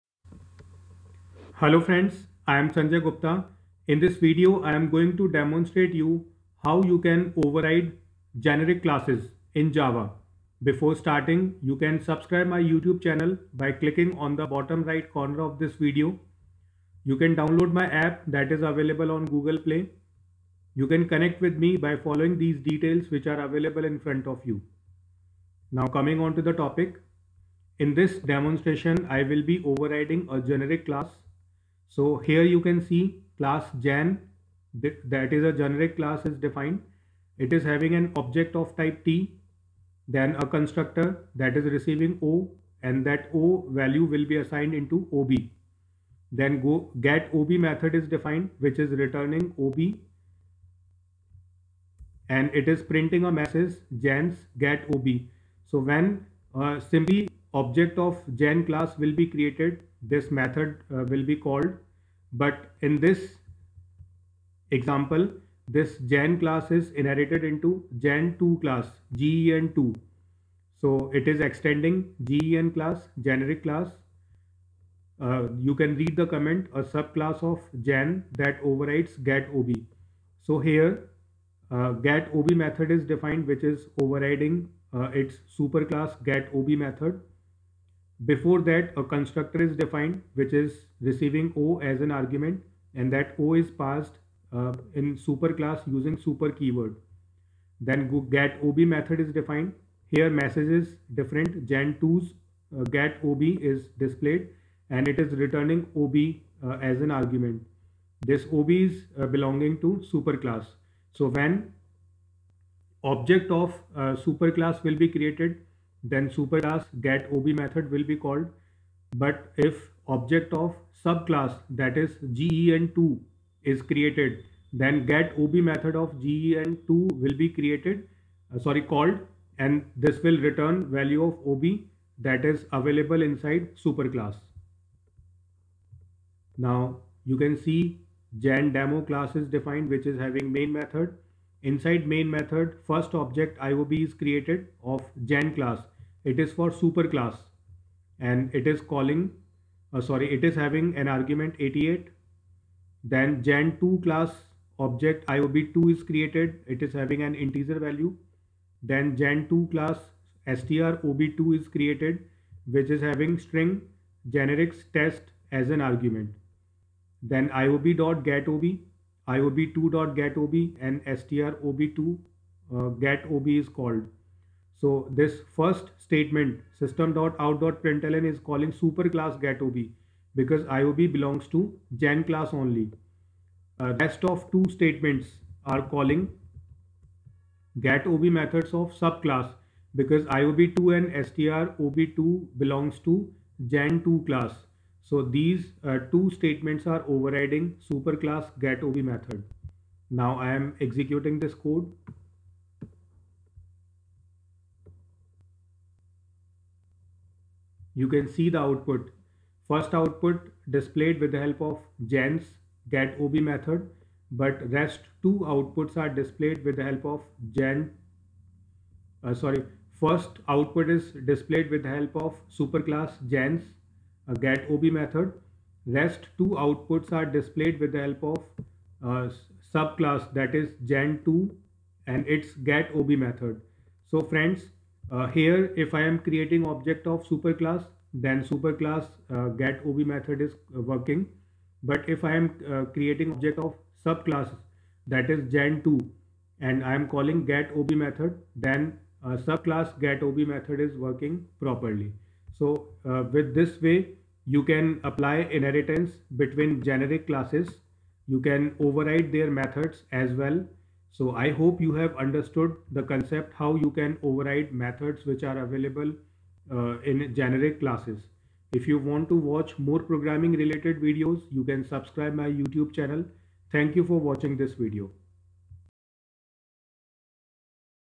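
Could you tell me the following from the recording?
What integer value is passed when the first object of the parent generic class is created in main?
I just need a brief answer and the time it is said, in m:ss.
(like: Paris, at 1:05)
88, at 2:31.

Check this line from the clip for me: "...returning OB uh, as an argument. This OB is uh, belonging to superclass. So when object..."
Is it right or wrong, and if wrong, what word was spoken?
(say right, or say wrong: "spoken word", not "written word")
right.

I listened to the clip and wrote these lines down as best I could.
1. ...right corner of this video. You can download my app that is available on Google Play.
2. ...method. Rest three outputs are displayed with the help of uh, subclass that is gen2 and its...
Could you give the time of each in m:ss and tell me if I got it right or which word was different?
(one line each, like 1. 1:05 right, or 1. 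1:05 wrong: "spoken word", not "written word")
1. 0:14 right
2. 3:44 wrong: "two", not "three".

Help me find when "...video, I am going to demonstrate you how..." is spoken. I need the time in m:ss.
0:04.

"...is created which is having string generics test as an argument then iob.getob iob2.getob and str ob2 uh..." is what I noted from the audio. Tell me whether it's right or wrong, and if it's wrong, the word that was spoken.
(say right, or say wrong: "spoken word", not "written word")
right.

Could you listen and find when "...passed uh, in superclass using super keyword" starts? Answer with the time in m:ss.
1:33.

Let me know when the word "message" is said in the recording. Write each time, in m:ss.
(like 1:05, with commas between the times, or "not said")
0:53, 1:40.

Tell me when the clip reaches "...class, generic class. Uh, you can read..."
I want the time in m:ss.
1:12.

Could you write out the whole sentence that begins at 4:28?
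If you want to watch more programming related videos, you can subscribe my YouTube channel.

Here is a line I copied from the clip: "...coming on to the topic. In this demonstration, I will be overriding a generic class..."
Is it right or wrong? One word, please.
right.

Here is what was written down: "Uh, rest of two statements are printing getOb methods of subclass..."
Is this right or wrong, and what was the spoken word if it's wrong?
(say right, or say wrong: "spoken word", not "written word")
wrong: "calling", not "printing".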